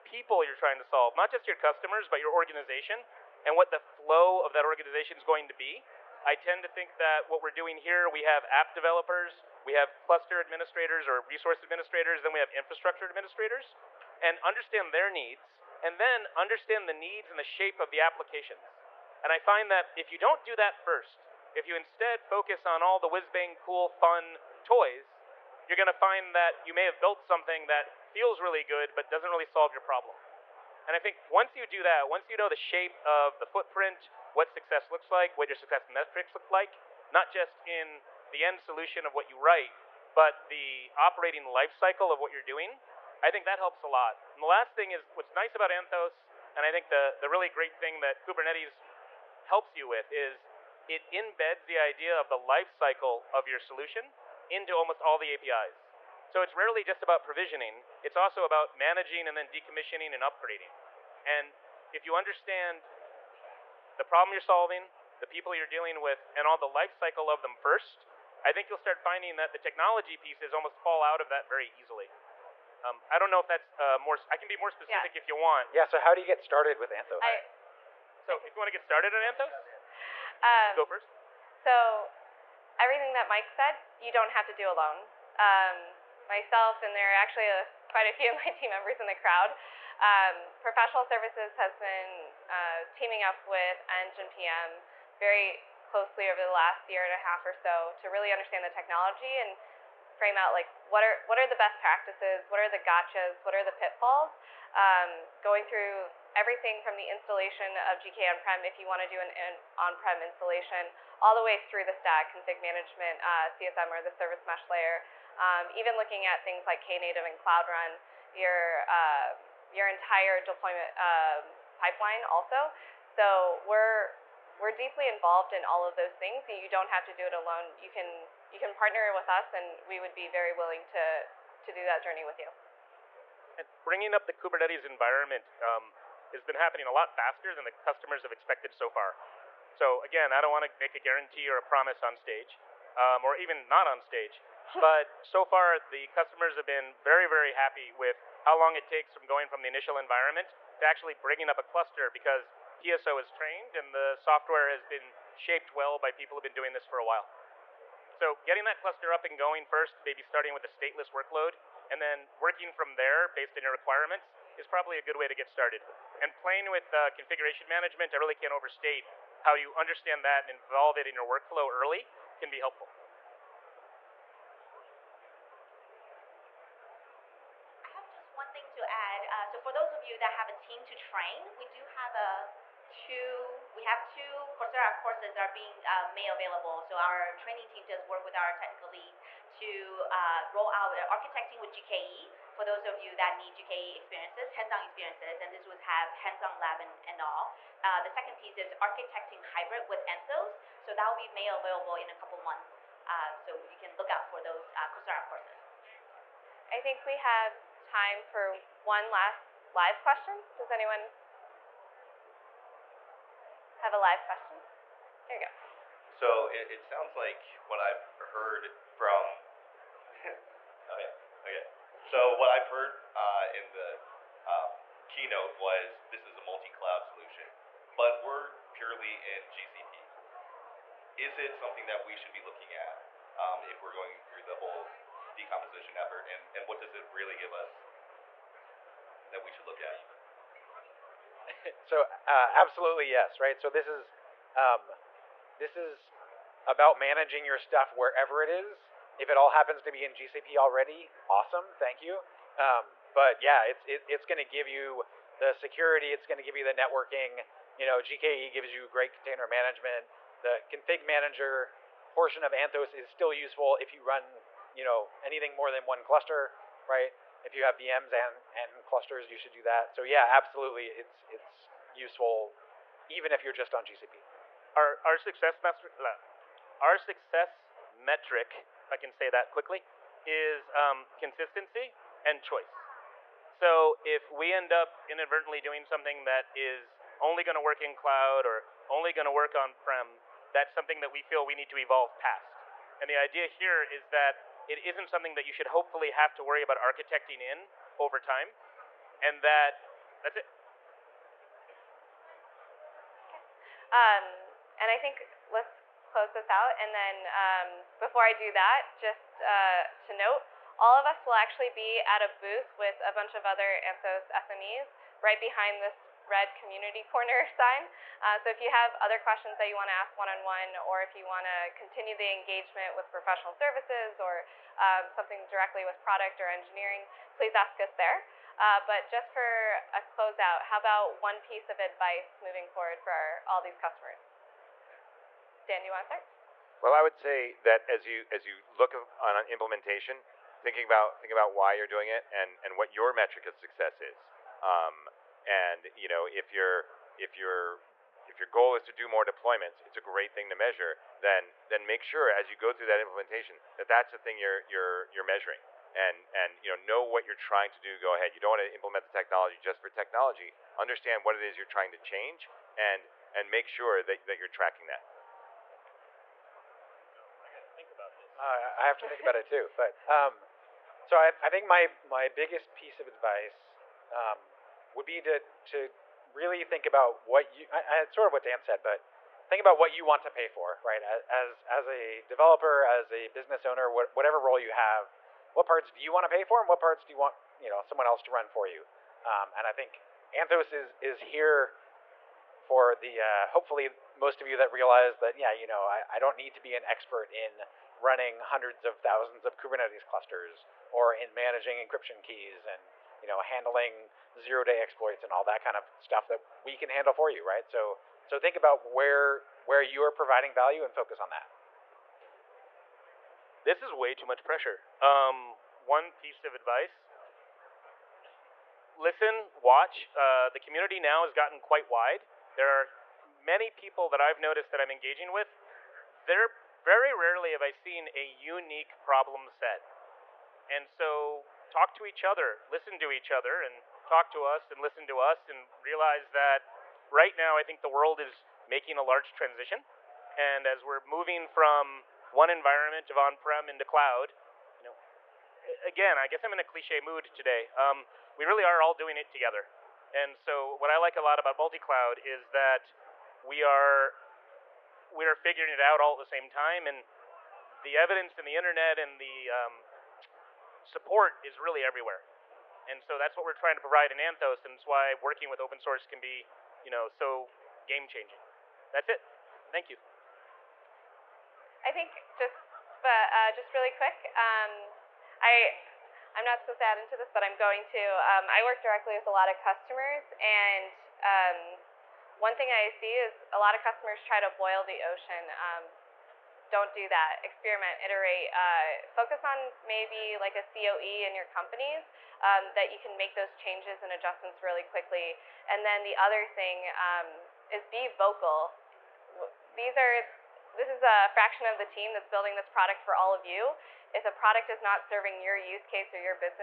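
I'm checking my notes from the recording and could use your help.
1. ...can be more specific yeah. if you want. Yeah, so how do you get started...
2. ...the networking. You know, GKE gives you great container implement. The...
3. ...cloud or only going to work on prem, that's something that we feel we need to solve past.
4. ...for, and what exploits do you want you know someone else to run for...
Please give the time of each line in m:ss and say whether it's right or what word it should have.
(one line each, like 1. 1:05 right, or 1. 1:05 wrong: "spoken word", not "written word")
1. 1:14 right
2. 4:16 wrong: "management", not "implement"
3. 4:47 wrong: "evolve", not "solve"
4. 6:26 wrong: "parts", not "exploits".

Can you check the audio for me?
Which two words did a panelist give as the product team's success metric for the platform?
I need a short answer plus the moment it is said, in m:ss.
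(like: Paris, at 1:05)
consistency and choice, at 4:41.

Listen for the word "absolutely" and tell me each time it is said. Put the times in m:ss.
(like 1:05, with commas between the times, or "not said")
4:02, 4:30.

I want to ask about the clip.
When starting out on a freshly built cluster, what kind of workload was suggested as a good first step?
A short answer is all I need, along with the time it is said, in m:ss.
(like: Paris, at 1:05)
stateless workload, at 2:40.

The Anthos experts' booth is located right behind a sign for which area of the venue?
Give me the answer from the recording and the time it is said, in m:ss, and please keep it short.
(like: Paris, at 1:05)
red community corner, at 5:16.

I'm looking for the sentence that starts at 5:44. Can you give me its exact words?
Um, and you know, if you're if your if your goal is to do more deployments, it's a great thing to measure.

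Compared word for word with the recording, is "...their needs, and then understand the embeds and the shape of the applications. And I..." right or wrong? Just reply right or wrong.
wrong.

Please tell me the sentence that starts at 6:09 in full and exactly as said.
But um, so I, I, think my my biggest piece of advice um, would be to to really think about what you.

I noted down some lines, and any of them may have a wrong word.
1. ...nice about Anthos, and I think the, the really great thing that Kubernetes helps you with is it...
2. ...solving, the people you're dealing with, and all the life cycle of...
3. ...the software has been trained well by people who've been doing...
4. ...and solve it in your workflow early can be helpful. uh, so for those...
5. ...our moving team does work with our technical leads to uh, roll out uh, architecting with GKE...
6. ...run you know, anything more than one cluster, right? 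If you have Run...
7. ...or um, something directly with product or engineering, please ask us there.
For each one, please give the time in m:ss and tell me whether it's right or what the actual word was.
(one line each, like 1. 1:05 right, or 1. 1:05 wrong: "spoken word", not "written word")
1. 0:45 right
2. 1:04 right
3. 2:33 wrong: "shaped", not "trained"
4. 2:50 wrong: "involve", not "solve"
5. 3:06 wrong: "training", not "moving"
6. 4:24 wrong: "VMs", not "Run"
7. 5:24 right.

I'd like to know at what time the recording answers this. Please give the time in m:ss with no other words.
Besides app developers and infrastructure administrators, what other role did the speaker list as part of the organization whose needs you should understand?
0:10.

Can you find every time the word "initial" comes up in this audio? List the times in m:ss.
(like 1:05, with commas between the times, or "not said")
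2:29.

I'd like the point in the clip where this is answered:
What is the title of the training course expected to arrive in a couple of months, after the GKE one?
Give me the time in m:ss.
3:18.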